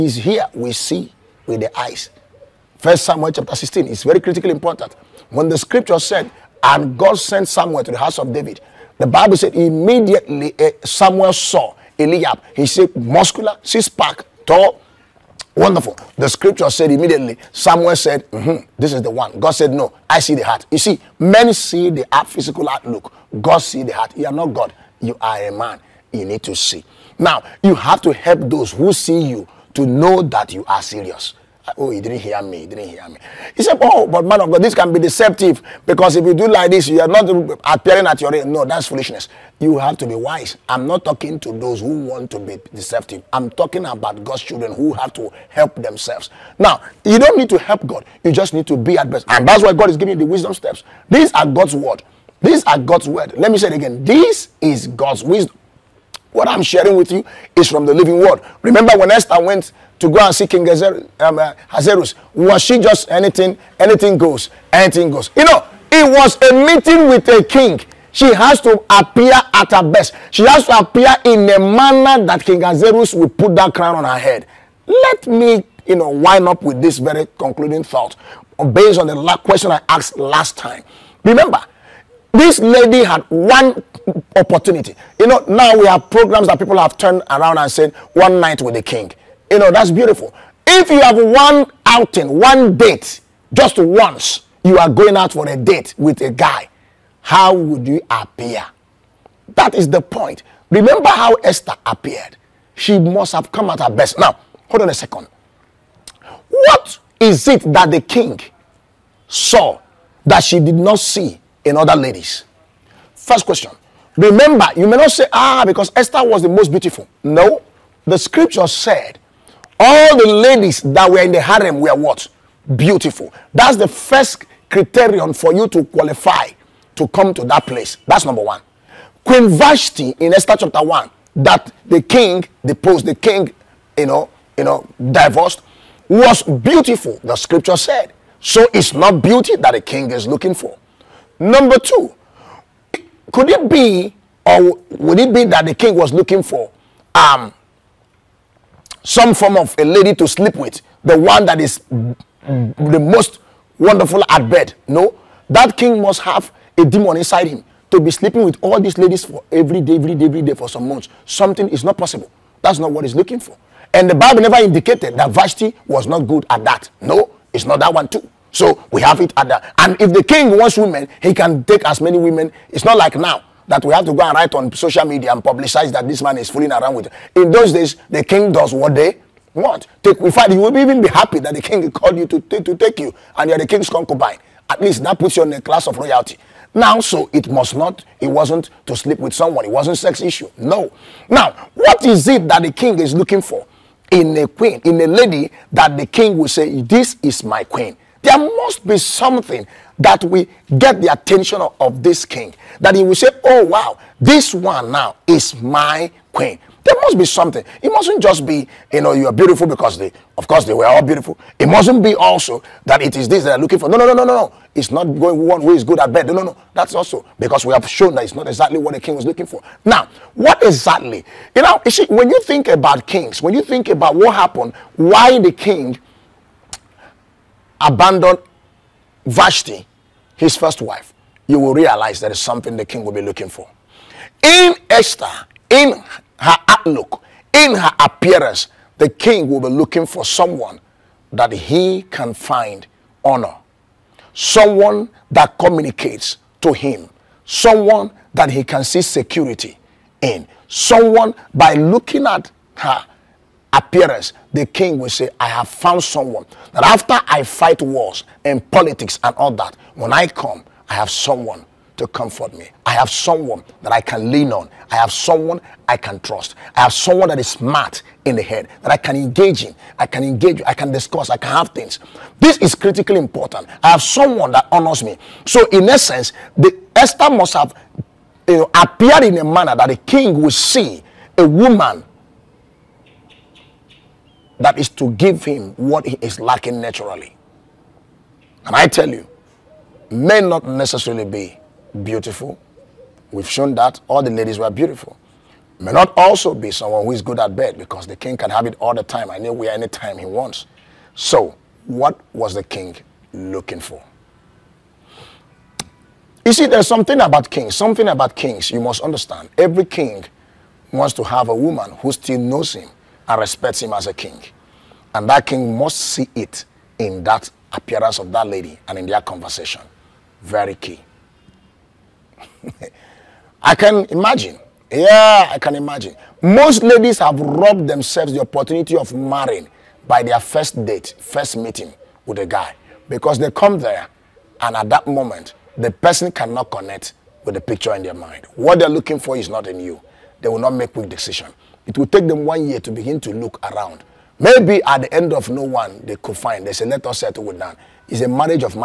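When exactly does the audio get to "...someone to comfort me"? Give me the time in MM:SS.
04:21.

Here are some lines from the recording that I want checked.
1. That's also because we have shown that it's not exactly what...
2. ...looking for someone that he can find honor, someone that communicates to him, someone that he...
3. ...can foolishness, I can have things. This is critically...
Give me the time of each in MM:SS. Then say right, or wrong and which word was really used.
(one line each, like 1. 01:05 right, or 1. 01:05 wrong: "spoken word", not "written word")
1. 03:36 right
2. 03:59 right
3. 04:30 wrong: "discuss", not "foolishness".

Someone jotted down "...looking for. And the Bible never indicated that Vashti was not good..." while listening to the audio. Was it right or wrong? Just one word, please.
right.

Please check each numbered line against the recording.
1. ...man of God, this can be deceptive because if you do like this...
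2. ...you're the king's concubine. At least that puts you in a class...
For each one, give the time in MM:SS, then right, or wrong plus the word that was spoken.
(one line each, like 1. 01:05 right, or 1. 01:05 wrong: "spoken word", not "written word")
1. 00:34 right
2. 03:03 right.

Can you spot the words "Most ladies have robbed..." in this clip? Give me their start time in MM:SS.
05:26.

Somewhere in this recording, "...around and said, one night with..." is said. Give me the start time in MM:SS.
01:27.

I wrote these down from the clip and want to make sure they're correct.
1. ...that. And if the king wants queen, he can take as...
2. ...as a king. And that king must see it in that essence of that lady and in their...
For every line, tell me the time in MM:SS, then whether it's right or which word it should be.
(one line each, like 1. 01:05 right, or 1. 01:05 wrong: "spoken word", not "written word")
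1. 02:49 wrong: "women", not "queen"
2. 05:13 wrong: "appearance", not "essence".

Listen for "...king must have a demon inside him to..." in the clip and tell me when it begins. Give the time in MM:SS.
02:35.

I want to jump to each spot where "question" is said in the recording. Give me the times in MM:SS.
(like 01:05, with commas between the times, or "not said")
01:19, 01:53.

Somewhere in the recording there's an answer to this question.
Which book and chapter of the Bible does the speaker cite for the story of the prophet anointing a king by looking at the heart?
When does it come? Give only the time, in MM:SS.
00:02.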